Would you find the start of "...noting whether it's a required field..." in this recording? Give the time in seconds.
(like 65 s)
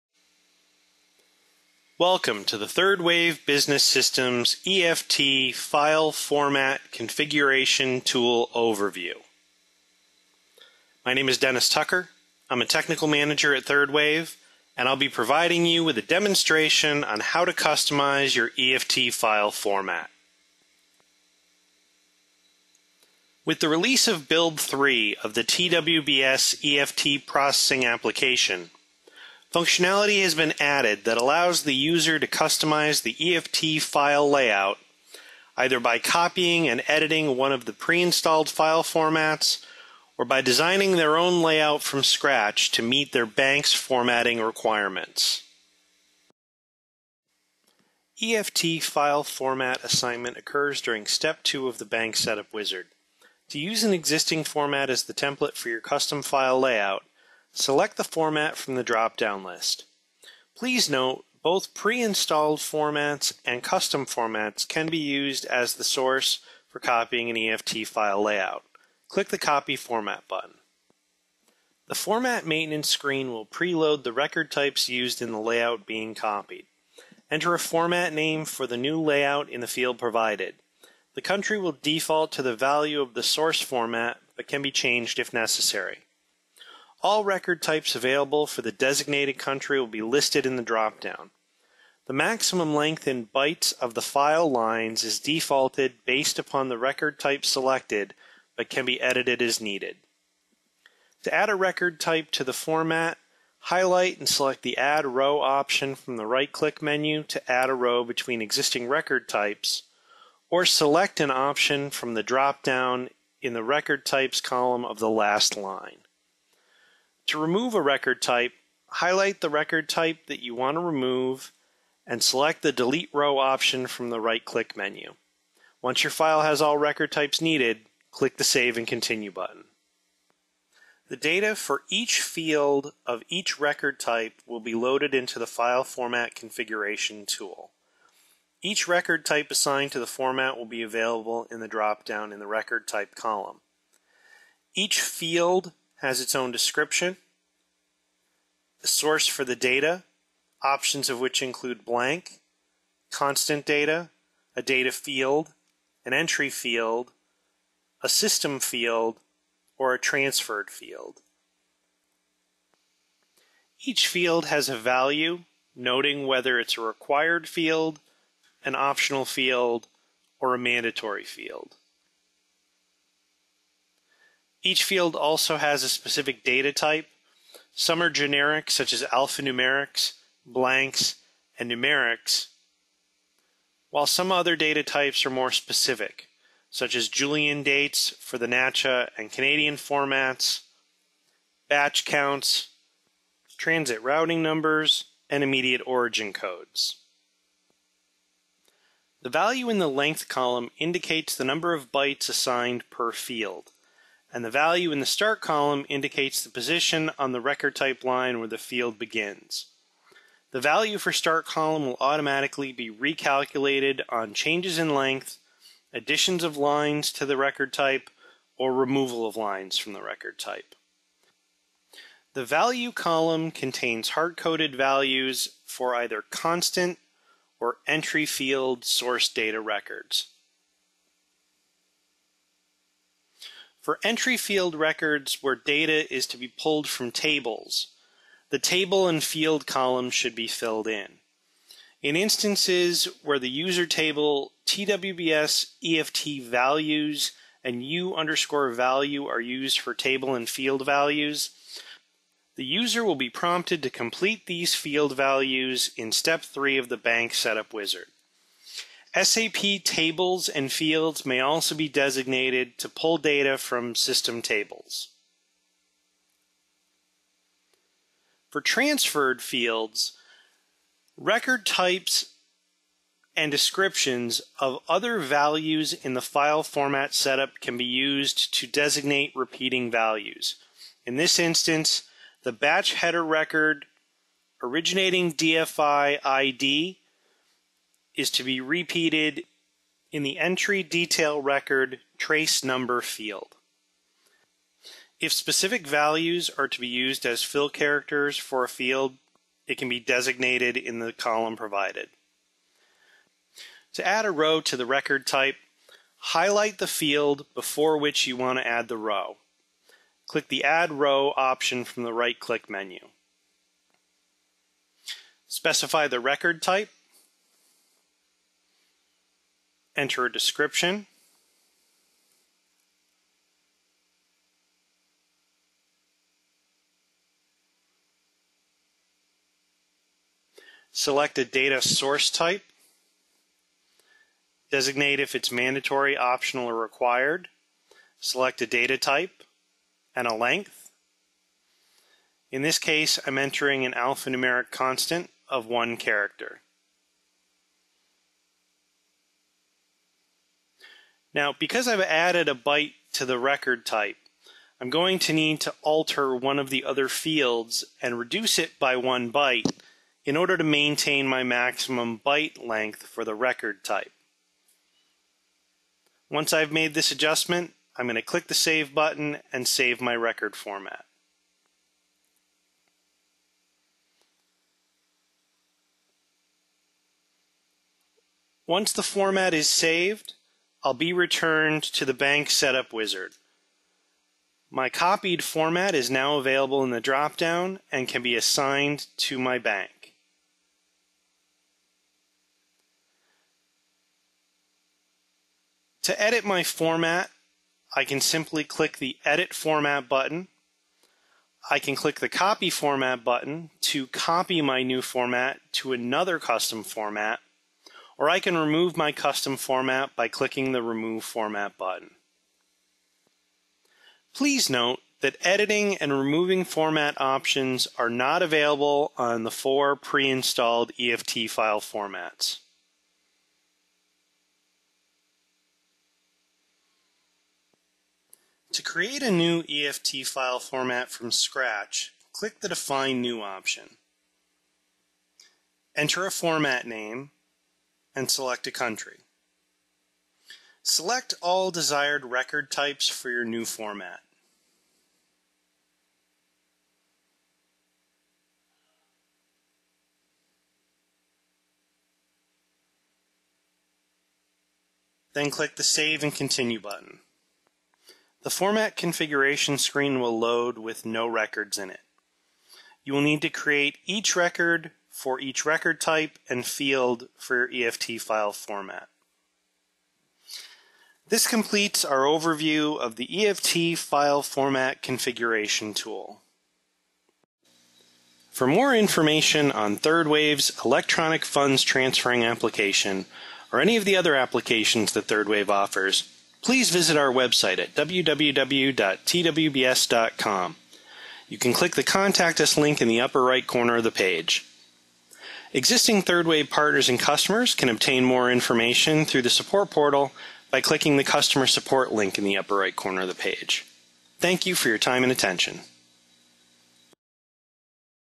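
165 s.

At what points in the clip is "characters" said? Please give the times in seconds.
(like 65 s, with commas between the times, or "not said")
297 s, 345 s.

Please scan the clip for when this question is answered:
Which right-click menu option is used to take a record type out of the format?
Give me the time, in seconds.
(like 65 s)
122 s.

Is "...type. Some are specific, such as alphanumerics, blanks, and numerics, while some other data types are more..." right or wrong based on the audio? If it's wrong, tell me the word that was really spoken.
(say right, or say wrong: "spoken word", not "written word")
wrong: "generic", not "specific".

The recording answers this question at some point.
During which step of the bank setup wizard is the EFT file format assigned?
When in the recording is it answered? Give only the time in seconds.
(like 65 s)
51 s.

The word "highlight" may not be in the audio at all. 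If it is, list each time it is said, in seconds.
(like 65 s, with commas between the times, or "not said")
103 s, 118 s, 306 s.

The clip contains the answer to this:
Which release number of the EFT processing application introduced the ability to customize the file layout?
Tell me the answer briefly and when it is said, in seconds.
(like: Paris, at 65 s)
Build 3, at 24 s.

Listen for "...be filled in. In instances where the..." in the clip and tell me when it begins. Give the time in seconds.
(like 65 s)
240 s.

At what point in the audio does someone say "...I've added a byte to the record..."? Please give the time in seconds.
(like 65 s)
351 s.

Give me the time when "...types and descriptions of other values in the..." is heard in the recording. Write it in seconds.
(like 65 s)
271 s.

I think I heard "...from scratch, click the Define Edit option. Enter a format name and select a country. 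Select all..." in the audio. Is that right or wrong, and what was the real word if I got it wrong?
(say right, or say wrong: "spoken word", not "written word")
wrong: "New", not "Edit".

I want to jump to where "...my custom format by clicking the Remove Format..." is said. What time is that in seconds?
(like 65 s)
408 s.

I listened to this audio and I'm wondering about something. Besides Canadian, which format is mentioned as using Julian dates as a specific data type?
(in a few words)
NACHA.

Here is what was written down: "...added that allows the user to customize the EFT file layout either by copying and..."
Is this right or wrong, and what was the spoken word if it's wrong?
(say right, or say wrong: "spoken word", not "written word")
right.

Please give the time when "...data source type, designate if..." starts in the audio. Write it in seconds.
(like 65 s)
331 s.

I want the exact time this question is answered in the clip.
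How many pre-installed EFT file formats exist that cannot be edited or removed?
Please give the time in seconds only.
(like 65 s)
419 s.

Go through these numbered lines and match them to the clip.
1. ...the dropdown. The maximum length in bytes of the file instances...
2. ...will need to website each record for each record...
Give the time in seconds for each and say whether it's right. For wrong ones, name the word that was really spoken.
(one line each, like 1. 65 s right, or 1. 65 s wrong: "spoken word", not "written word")
1. 90 s wrong: "lines", not "instances"
2. 463 s wrong: "create", not "website".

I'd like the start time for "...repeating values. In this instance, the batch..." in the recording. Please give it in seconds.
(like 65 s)
279 s.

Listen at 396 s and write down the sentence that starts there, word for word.
To edit my format, I can simply click the Edit Format button.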